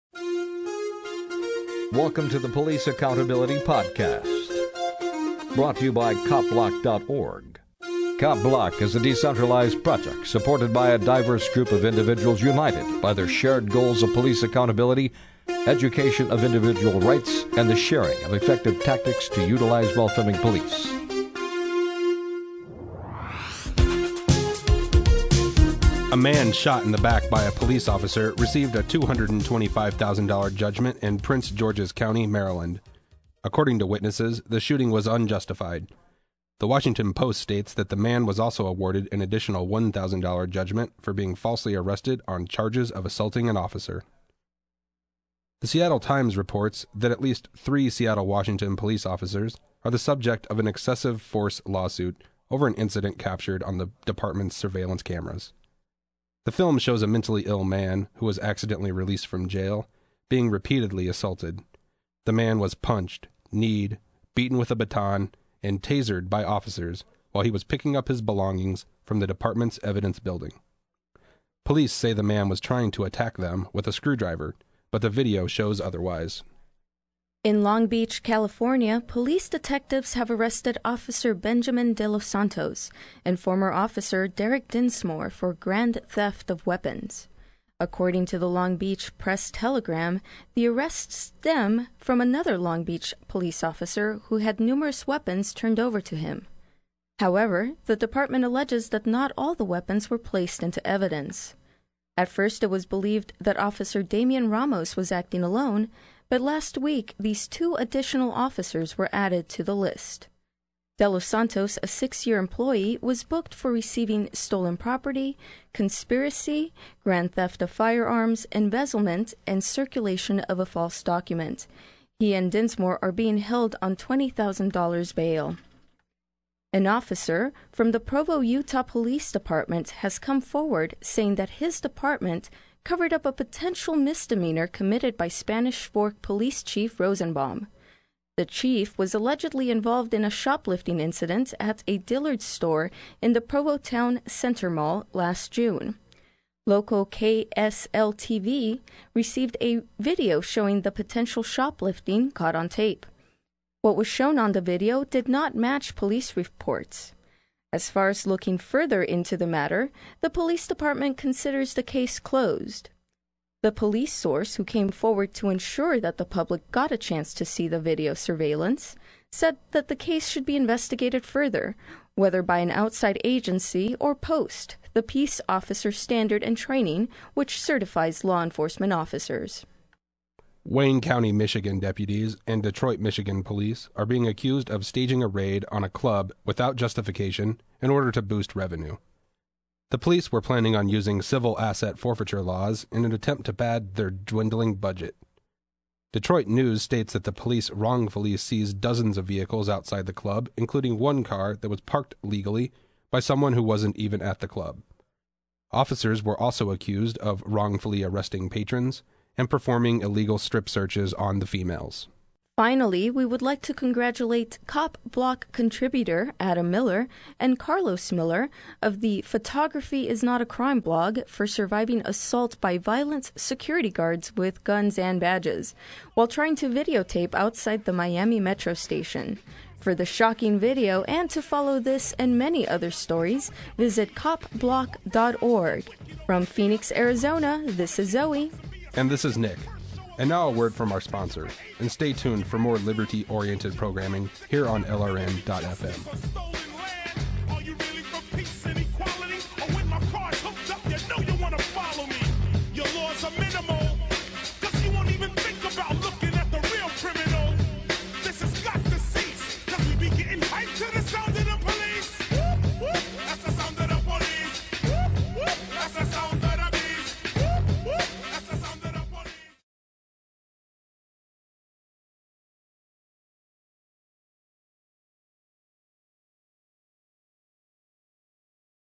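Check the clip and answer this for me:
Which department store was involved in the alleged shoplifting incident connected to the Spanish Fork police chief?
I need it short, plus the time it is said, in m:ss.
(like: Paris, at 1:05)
Dillard's, at 2:21.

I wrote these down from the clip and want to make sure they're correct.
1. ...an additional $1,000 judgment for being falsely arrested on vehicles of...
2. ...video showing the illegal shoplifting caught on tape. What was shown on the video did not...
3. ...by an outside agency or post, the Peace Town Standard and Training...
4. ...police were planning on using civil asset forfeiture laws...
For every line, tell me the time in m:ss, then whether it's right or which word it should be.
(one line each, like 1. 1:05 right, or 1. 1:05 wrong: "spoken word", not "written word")
1. 0:39 wrong: "charges", not "vehicles"
2. 2:29 wrong: "potential", not "illegal"
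3. 2:52 wrong: "Officer", not "Town"
4. 3:09 right.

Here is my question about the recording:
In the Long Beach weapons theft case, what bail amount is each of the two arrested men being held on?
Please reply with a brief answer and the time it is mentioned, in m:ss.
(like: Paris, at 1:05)
$20,000, at 2:03.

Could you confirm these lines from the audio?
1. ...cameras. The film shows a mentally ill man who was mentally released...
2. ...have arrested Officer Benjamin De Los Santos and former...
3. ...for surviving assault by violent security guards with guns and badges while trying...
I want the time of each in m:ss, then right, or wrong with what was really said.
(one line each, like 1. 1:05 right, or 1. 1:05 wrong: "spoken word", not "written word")
1. 0:55 wrong: "accidentally", not "mentally"
2. 1:20 right
3. 3:41 right.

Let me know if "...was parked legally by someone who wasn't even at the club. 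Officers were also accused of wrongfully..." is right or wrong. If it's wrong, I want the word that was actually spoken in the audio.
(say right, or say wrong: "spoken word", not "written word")
right.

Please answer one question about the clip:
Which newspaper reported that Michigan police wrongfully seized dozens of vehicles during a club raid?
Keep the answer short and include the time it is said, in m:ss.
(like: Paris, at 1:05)
Detroit News, at 3:16.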